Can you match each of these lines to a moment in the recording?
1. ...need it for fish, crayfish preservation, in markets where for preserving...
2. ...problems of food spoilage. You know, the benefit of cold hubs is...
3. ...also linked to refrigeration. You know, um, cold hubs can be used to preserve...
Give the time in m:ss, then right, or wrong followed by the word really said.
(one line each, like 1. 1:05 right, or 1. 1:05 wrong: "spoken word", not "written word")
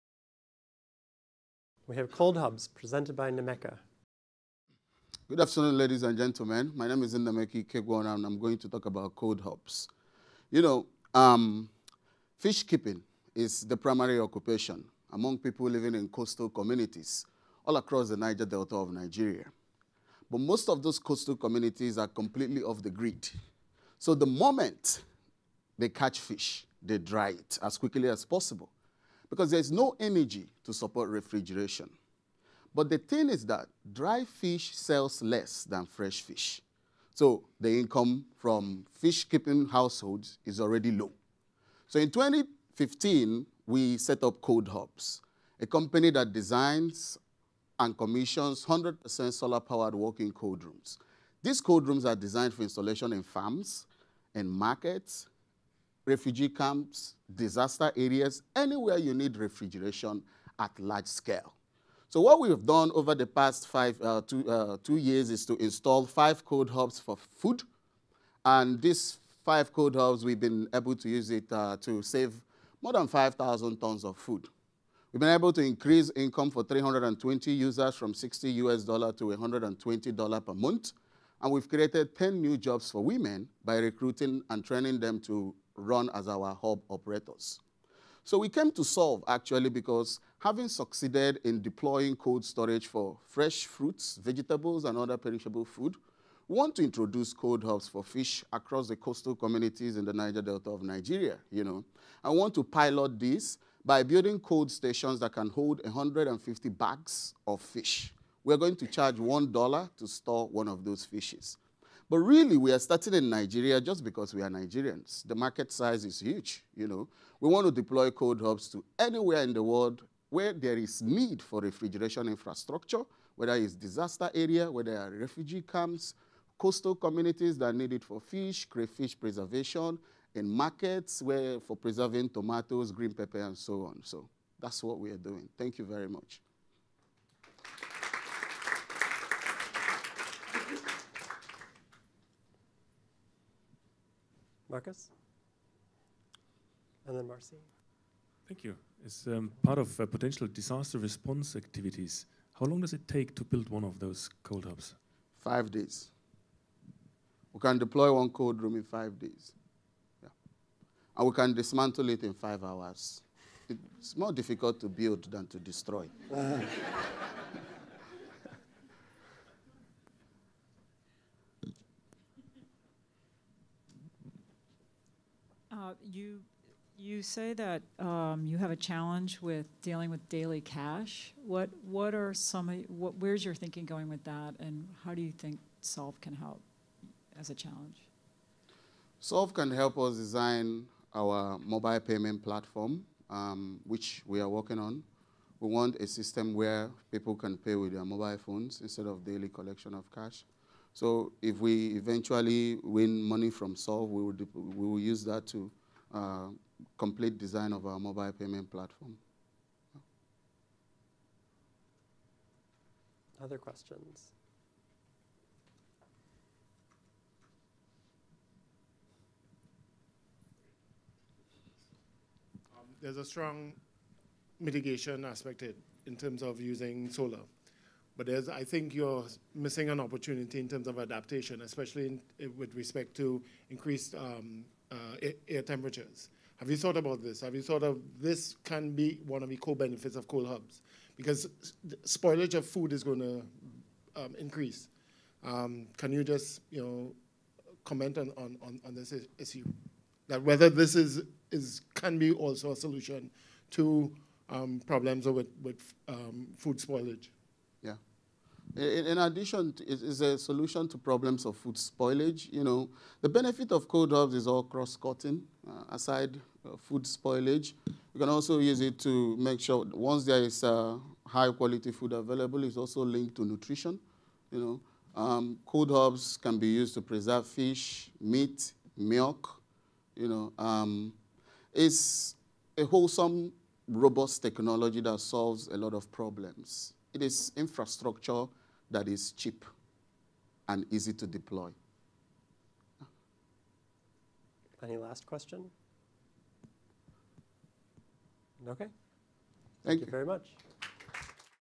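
1. 2:07 right
2. 4:20 right
3. 4:32 wrong: "nutrition", not "refrigeration".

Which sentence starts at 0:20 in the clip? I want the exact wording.
But most of those coastal communities are completely off the grid.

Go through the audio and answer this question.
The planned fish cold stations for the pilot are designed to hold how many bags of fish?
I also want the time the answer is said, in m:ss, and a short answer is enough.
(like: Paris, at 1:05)
150, at 1:45.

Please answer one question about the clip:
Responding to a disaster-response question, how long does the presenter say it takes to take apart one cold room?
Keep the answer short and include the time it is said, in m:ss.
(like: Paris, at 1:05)
5 hours, at 2:42.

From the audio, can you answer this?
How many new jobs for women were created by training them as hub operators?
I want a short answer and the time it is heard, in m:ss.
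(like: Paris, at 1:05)
10, at 1:22.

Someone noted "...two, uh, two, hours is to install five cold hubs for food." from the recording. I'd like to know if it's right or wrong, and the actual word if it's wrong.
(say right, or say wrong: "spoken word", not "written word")
wrong: "years", not "hours".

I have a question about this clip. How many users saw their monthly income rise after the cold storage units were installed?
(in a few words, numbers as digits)
320.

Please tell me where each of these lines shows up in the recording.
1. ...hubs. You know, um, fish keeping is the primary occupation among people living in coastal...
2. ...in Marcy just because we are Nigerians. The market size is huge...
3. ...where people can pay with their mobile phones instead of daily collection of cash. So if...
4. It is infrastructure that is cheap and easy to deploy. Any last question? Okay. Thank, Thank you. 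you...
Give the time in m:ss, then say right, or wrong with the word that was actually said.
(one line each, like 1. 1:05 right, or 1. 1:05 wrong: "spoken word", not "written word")
1. 0:09 right
2. 1:53 wrong: "Nigeria", not "Marcy"
3. 3:16 right
4. 4:47 right.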